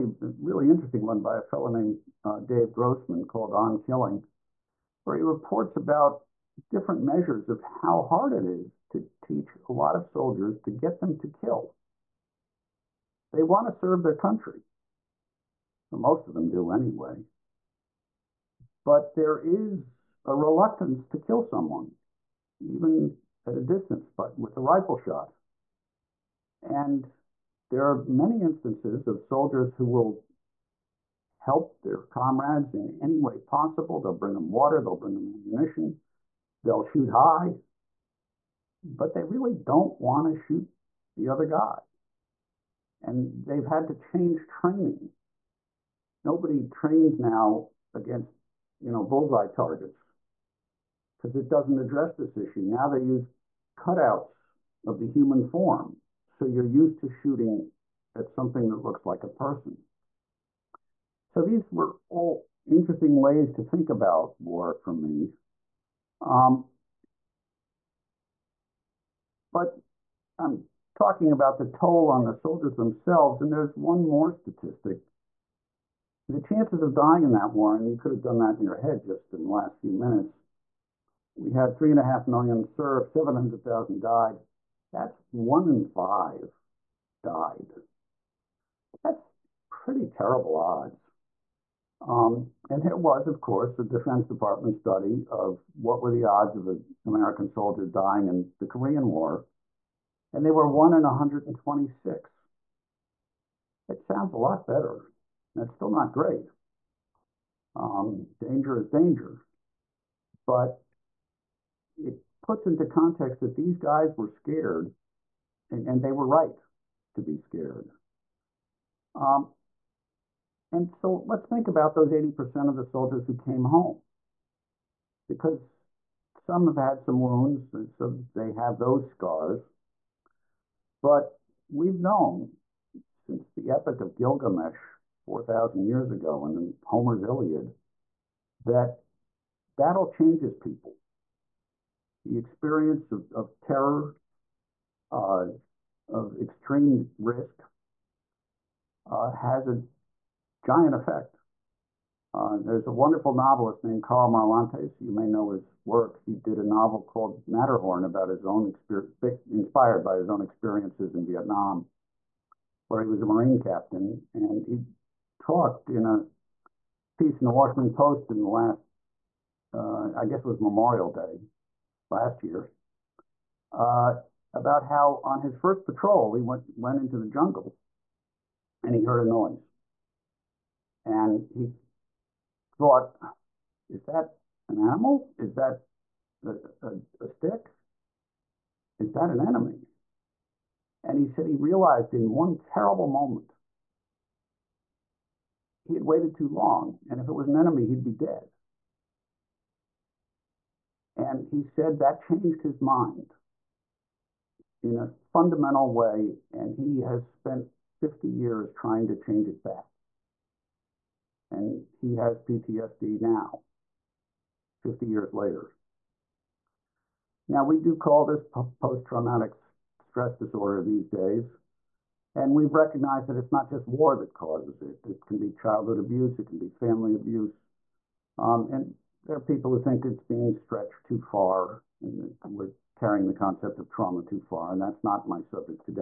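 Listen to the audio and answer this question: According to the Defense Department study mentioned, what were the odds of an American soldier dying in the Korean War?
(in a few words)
1 in 126.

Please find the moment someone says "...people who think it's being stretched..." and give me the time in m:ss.
3:49.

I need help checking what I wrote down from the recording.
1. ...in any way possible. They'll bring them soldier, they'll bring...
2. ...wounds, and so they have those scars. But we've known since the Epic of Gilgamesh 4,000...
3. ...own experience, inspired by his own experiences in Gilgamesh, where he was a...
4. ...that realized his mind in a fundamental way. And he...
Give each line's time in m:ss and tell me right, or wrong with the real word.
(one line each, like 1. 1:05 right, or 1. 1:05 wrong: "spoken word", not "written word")
1. 0:32 wrong: "water", not "soldier"
2. 2:07 right
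3. 2:38 wrong: "Vietnam", not "Gilgamesh"
4. 3:21 wrong: "changed", not "realized".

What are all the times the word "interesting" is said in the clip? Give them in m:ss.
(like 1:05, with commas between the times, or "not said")
0:00, 1:02.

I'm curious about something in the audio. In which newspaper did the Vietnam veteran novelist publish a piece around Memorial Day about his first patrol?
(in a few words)
Washington Post.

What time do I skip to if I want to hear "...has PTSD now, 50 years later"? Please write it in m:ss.
3:32.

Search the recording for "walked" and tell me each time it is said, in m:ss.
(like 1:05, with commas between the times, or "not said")
not said.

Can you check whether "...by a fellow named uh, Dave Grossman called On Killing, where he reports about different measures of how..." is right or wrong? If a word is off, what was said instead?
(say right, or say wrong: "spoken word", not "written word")
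right.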